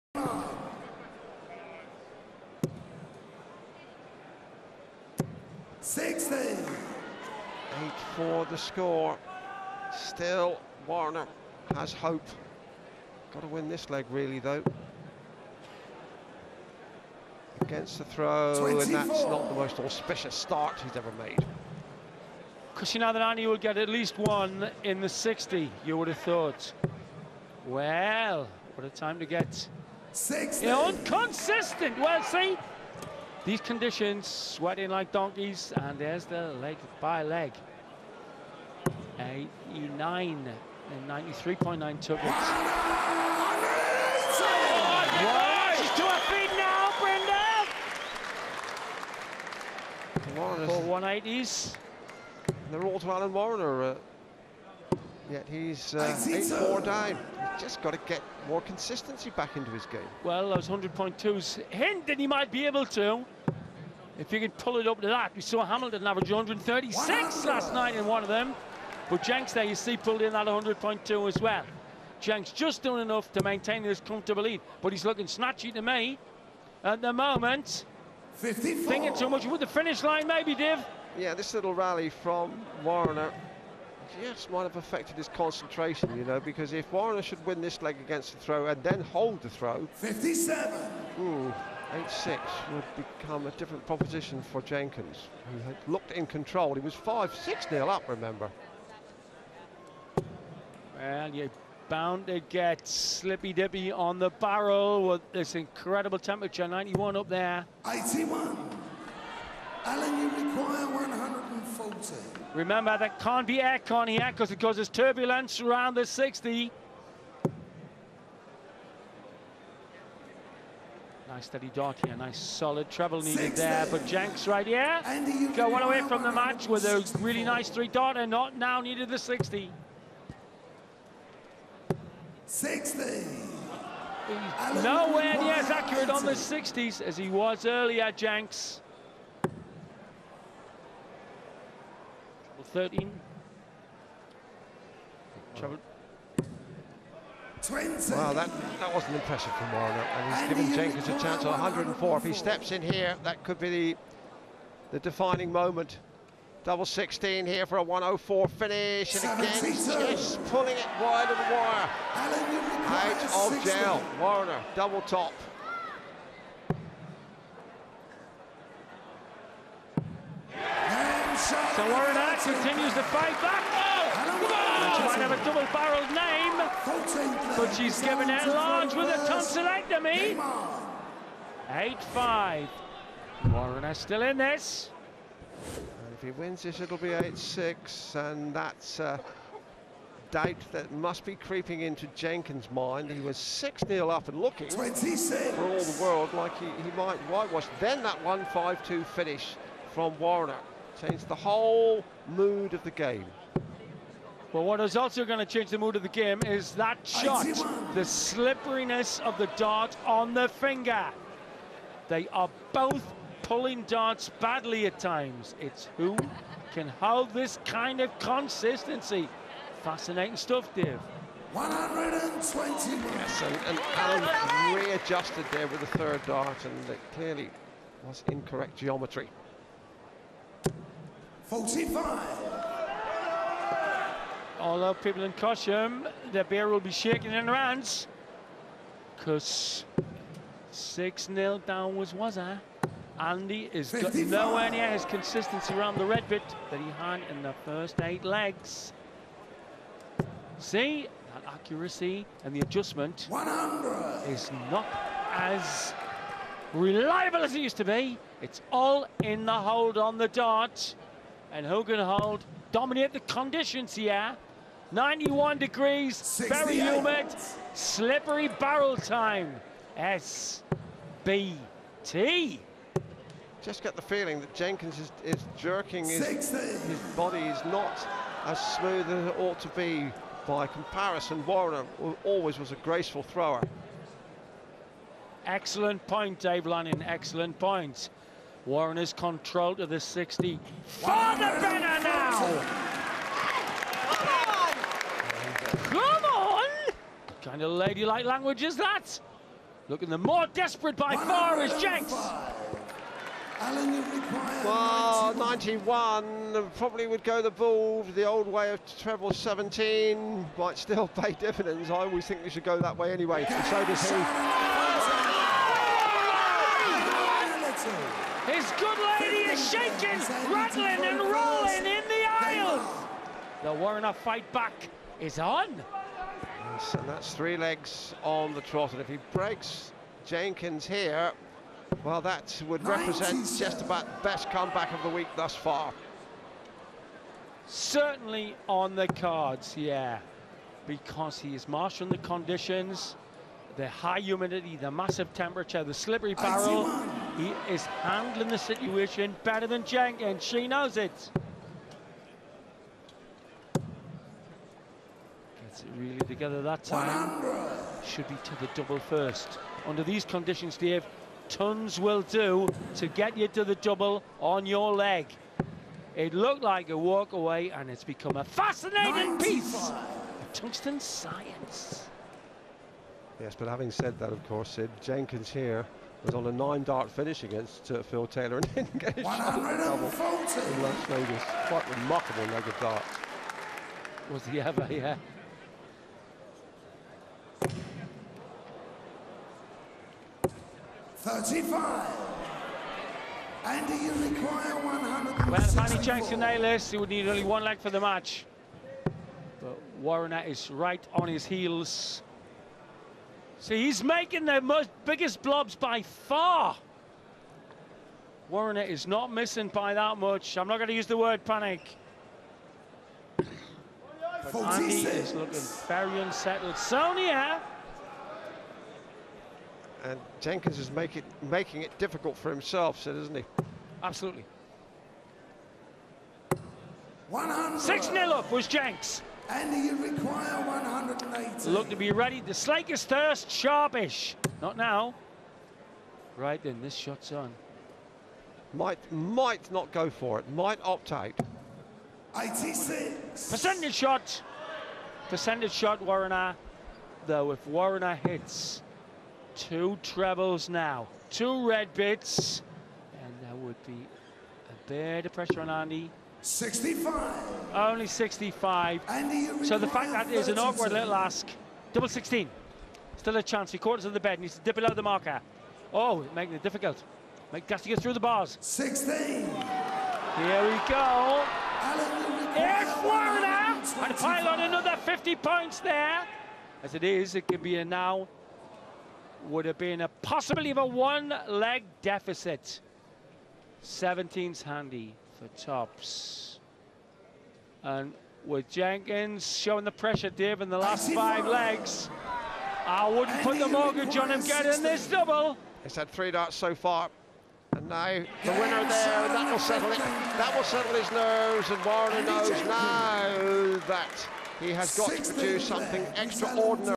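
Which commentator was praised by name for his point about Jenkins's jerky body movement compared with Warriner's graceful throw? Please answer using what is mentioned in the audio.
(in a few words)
Dave Lanning.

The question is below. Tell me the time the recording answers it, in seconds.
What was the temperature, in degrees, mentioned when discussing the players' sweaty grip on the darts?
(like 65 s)
264 s.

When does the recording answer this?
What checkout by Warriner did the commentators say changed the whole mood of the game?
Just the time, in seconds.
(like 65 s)
198 s.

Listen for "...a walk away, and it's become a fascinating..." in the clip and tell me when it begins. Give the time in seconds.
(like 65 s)
366 s.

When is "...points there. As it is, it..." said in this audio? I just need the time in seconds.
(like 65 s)
475 s.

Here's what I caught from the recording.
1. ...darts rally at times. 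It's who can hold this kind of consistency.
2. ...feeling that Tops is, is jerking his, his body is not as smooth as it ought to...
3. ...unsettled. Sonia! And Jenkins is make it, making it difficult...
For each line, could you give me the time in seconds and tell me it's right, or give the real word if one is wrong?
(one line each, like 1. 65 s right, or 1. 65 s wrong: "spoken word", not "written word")
1. 213 s wrong: "badly", not "rally"
2. 274 s wrong: "Jenkins", not "Tops"
3. 416 s right.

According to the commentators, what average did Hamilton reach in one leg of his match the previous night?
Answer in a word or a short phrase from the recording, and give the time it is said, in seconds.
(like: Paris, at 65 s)
136, at 66 s.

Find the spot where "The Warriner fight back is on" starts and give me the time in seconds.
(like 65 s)
323 s.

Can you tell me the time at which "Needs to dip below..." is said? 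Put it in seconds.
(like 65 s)
464 s.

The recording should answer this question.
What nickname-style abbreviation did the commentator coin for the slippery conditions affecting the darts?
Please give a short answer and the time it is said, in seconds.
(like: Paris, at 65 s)
SBT, at 269 s.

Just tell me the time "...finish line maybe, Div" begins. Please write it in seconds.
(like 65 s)
79 s.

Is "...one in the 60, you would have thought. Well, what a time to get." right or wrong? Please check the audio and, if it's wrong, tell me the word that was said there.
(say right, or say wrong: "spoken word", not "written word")
right.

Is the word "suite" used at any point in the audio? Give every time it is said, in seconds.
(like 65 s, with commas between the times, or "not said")
not said.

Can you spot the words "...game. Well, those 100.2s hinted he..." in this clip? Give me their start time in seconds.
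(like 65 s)
59 s.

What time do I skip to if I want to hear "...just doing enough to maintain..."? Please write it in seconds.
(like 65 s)
72 s.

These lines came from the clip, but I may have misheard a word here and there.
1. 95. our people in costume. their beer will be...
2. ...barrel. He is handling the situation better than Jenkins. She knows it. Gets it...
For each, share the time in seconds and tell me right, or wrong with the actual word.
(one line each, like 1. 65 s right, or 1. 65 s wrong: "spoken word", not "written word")
1. 231 s wrong: "45", not "95"
2. 346 s right.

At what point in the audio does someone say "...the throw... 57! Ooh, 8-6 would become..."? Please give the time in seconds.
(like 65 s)
89 s.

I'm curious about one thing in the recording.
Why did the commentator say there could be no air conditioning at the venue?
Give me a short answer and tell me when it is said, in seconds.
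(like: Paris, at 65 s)
It causes turbulence, at 114 s.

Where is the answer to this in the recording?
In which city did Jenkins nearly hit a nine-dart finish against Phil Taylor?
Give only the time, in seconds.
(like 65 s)
380 s.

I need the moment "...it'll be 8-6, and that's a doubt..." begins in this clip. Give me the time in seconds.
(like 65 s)
186 s.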